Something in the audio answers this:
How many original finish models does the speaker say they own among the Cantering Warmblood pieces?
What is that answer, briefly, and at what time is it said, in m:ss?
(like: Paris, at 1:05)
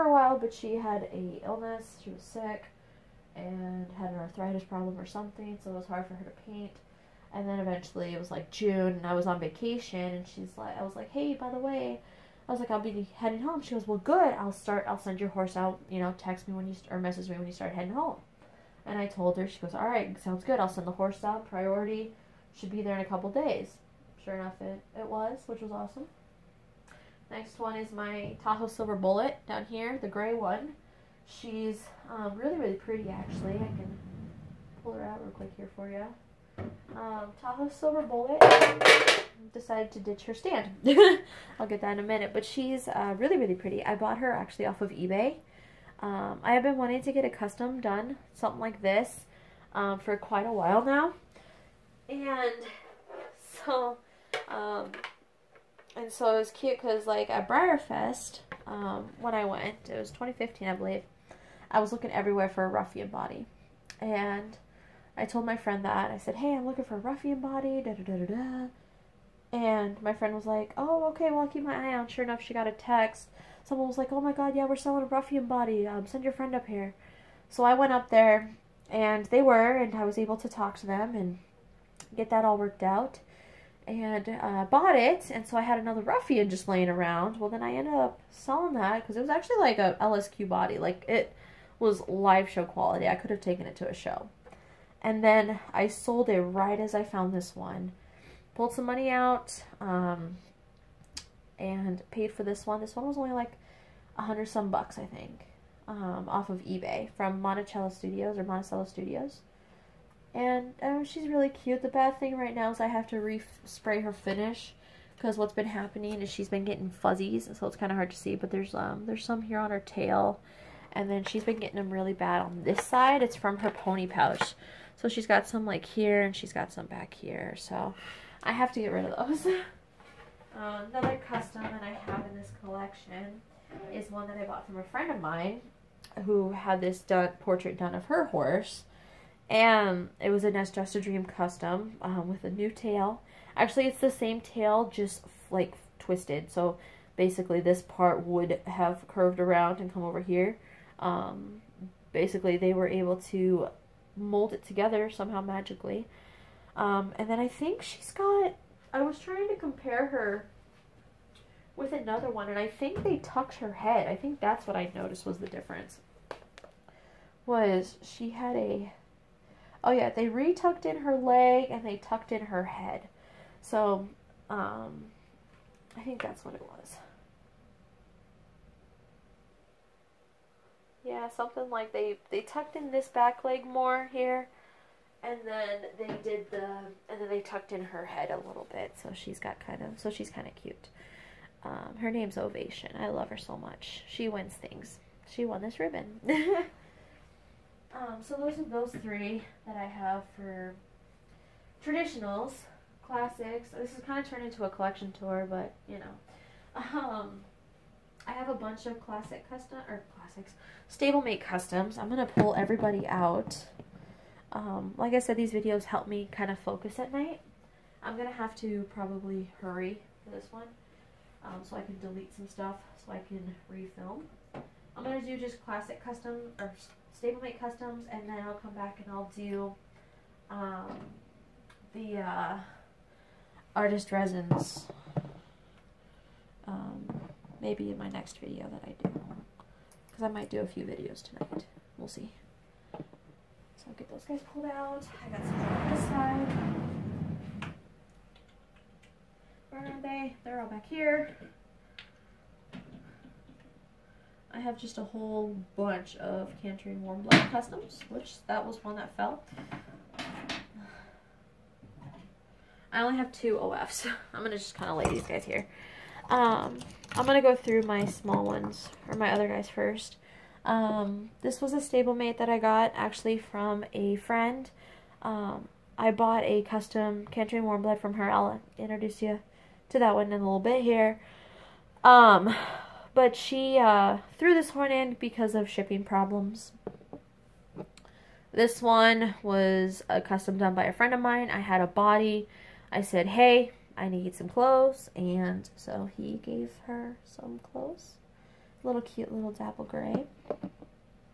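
2, at 4:23.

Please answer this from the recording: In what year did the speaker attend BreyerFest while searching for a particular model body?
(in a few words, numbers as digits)
2015.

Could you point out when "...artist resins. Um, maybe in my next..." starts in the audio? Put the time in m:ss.
3:53.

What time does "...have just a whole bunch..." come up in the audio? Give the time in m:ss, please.
4:14.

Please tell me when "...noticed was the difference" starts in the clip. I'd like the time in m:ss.
2:44.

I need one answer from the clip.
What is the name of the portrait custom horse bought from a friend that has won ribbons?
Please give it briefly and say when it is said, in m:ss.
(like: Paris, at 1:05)
Ovation, at 3:11.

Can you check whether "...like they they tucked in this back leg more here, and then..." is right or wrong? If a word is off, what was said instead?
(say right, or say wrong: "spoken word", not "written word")
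right.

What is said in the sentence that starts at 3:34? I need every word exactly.
Um, like I said, these videos help me kind of focus at night.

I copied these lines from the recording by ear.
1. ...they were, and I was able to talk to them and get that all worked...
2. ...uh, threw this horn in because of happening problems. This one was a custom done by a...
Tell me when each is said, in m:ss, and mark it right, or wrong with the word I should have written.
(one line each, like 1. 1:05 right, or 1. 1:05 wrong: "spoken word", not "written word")
1. 1:19 right
2. 4:43 wrong: "shipping", not "happening".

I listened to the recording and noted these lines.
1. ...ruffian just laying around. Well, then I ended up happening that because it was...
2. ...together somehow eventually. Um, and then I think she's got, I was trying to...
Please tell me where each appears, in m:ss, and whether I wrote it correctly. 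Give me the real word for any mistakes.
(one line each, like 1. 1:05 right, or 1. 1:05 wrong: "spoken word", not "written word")
1. 1:26 wrong: "selling", not "happening"
2. 2:34 wrong: "magically", not "eventually".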